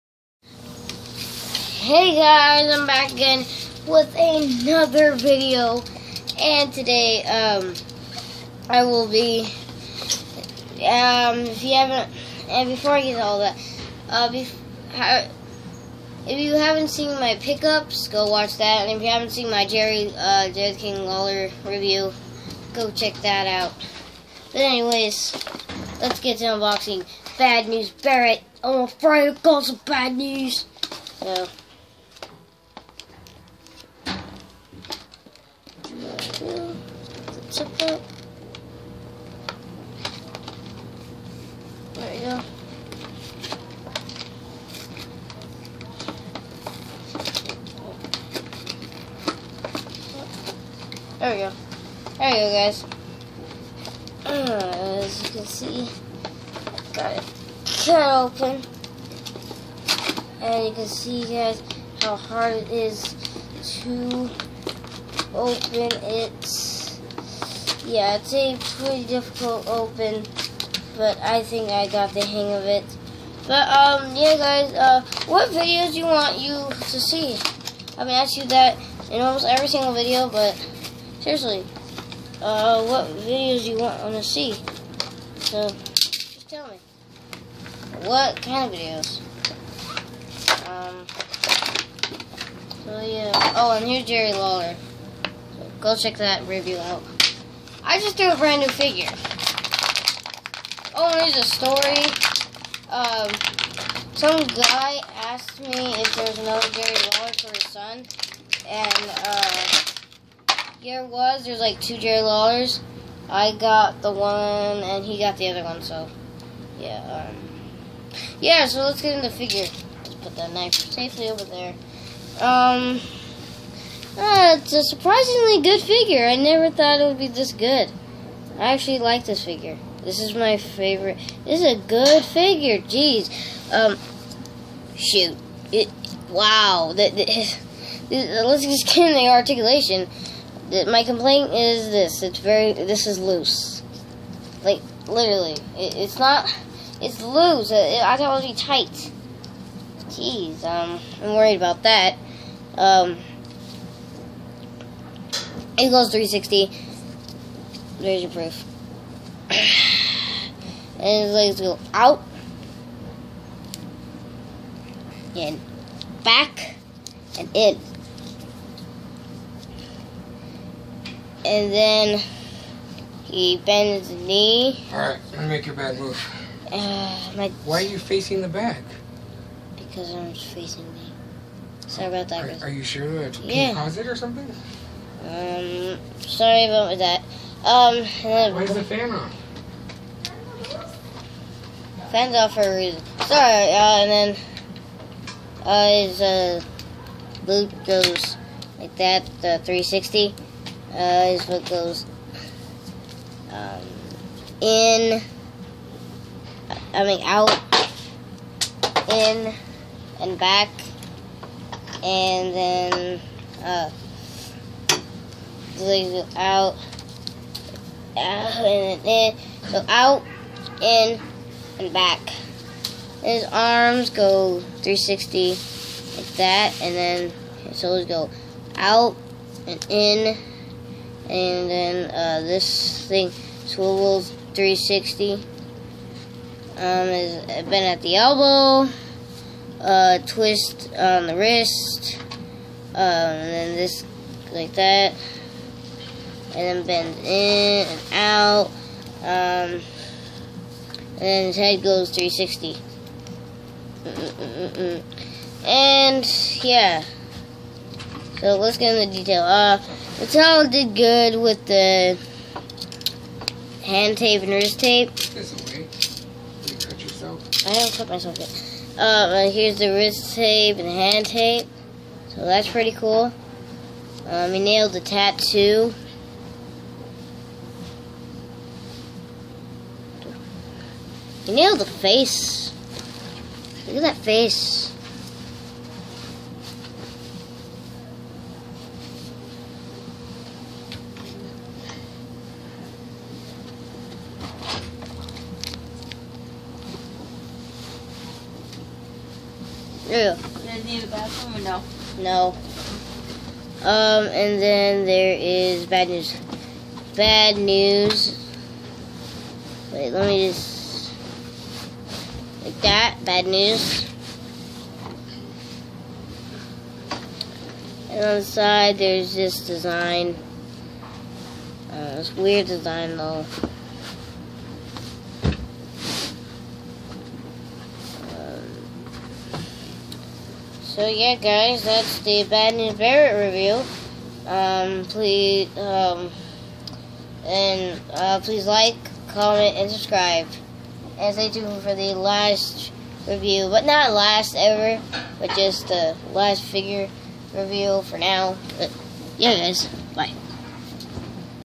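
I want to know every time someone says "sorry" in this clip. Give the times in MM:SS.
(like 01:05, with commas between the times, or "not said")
03:01, 03:06, 03:13.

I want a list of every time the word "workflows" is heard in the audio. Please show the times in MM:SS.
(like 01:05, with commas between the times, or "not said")
not said.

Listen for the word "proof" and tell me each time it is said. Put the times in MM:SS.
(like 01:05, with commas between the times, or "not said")
02:38.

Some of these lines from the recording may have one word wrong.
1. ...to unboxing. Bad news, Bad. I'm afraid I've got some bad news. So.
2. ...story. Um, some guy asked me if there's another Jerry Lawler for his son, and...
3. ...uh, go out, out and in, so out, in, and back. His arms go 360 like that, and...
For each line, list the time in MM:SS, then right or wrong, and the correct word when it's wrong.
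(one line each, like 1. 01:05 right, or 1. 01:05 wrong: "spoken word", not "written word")
1. 00:26 wrong: "Barrett", not "Bad"
2. 01:41 right
3. 03:33 right.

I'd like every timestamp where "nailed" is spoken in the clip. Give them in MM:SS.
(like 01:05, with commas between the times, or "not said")
04:34, 04:41.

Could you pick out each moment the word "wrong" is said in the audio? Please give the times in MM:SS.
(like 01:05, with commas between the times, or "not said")
not said.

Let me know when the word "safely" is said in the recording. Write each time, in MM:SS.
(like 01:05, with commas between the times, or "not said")
02:00.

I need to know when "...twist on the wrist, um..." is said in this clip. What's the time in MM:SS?
04:00.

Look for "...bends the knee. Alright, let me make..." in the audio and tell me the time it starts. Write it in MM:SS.
02:53.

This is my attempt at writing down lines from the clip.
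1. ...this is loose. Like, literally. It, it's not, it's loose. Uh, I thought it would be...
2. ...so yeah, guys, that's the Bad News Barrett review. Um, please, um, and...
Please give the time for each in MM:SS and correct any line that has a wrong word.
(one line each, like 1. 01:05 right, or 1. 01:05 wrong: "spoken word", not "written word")
1. 02:22 right
2. 05:30 right.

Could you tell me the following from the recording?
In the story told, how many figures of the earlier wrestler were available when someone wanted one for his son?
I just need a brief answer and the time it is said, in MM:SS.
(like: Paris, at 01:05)
2, at 01:51.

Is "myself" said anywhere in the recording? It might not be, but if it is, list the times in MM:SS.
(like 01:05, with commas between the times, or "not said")
04:28.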